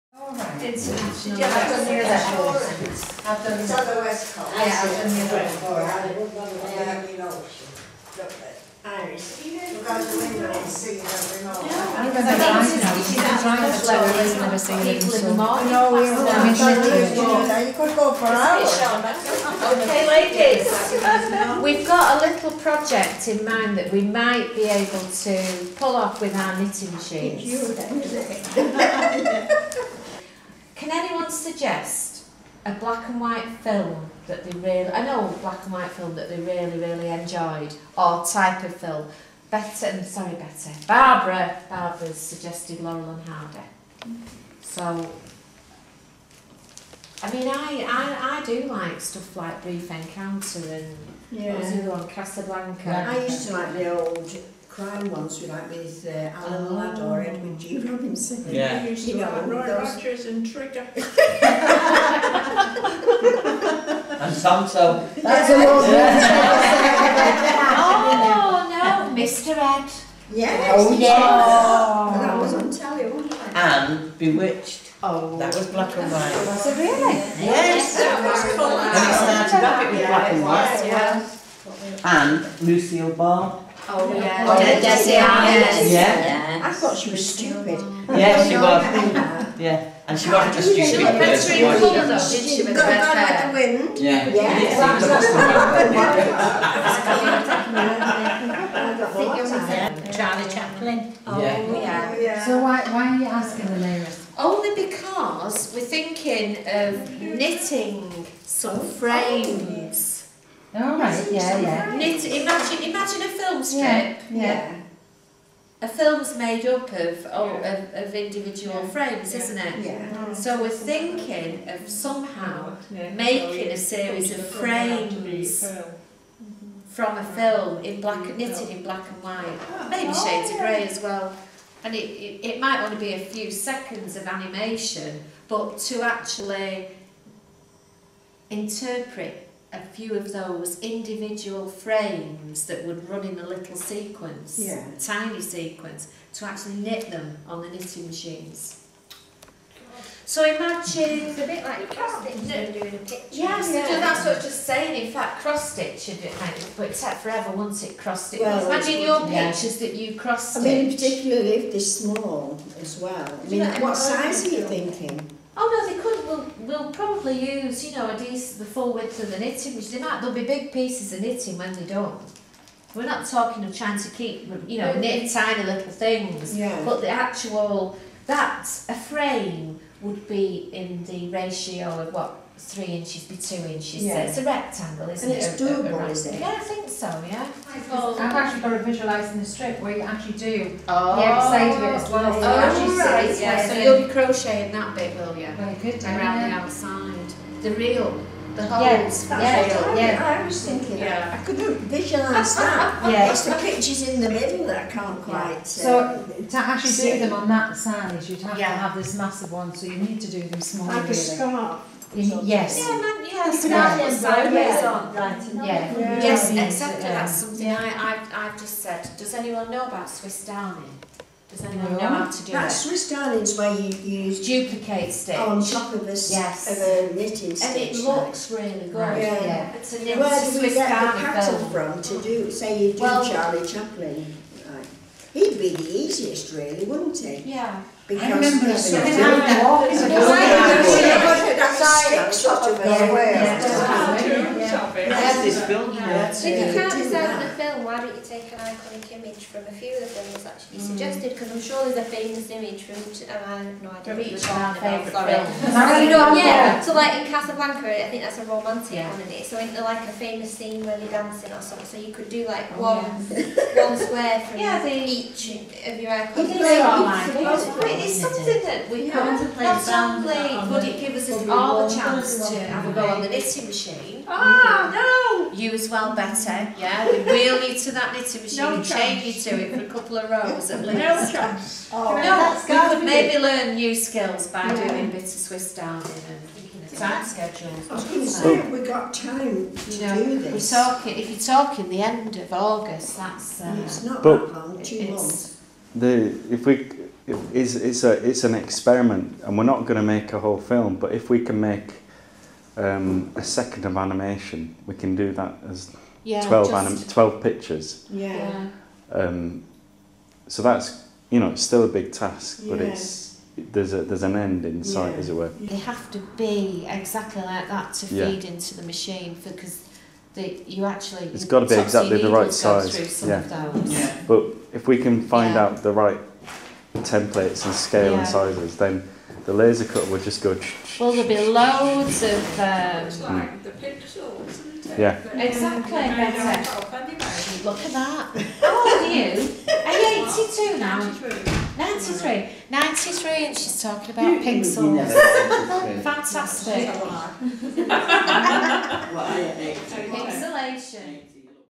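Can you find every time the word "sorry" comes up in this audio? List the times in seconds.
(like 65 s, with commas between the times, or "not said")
40 s, 254 s.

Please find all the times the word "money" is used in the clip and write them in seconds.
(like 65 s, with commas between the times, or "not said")
not said.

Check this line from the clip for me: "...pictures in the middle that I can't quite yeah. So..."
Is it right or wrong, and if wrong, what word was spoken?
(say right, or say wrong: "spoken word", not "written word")
right.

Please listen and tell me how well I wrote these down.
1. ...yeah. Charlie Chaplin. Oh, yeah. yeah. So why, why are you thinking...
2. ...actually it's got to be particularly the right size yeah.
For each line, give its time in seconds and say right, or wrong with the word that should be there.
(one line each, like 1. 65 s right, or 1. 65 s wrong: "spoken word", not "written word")
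1. 99 s wrong: "asking", not "thinking"
2. 320 s wrong: "exactly", not "particularly".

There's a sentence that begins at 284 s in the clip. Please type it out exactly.
doing bits of Swiss darning and time schedules.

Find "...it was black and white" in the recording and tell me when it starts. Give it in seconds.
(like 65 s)
79 s.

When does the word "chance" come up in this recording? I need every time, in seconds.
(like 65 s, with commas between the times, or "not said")
271 s, 281 s.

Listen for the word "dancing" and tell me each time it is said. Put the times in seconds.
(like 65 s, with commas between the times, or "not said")
261 s.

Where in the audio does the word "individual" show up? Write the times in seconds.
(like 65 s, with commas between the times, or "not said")
118 s, 140 s.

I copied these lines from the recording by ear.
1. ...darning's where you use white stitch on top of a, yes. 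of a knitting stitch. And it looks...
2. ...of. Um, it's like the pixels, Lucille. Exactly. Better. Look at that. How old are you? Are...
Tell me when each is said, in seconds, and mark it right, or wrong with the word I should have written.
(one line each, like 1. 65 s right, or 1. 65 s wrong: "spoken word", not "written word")
1. 223 s wrong: "duplicate", not "white"
2. 332 s wrong: "Yeah", not "Lucille".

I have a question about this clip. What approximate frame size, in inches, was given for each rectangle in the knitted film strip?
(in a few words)
3 inches by 2 inches.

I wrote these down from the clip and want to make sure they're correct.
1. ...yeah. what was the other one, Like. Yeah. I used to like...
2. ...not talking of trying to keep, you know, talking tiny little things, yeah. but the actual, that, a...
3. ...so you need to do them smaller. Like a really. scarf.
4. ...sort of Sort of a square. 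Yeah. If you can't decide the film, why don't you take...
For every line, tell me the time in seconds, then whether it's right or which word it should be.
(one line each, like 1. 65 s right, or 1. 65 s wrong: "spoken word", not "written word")
1. 51 s wrong: "Casablanca", not "Like"
2. 173 s wrong: "knitting", not "talking"
3. 209 s right
4. 238 s right.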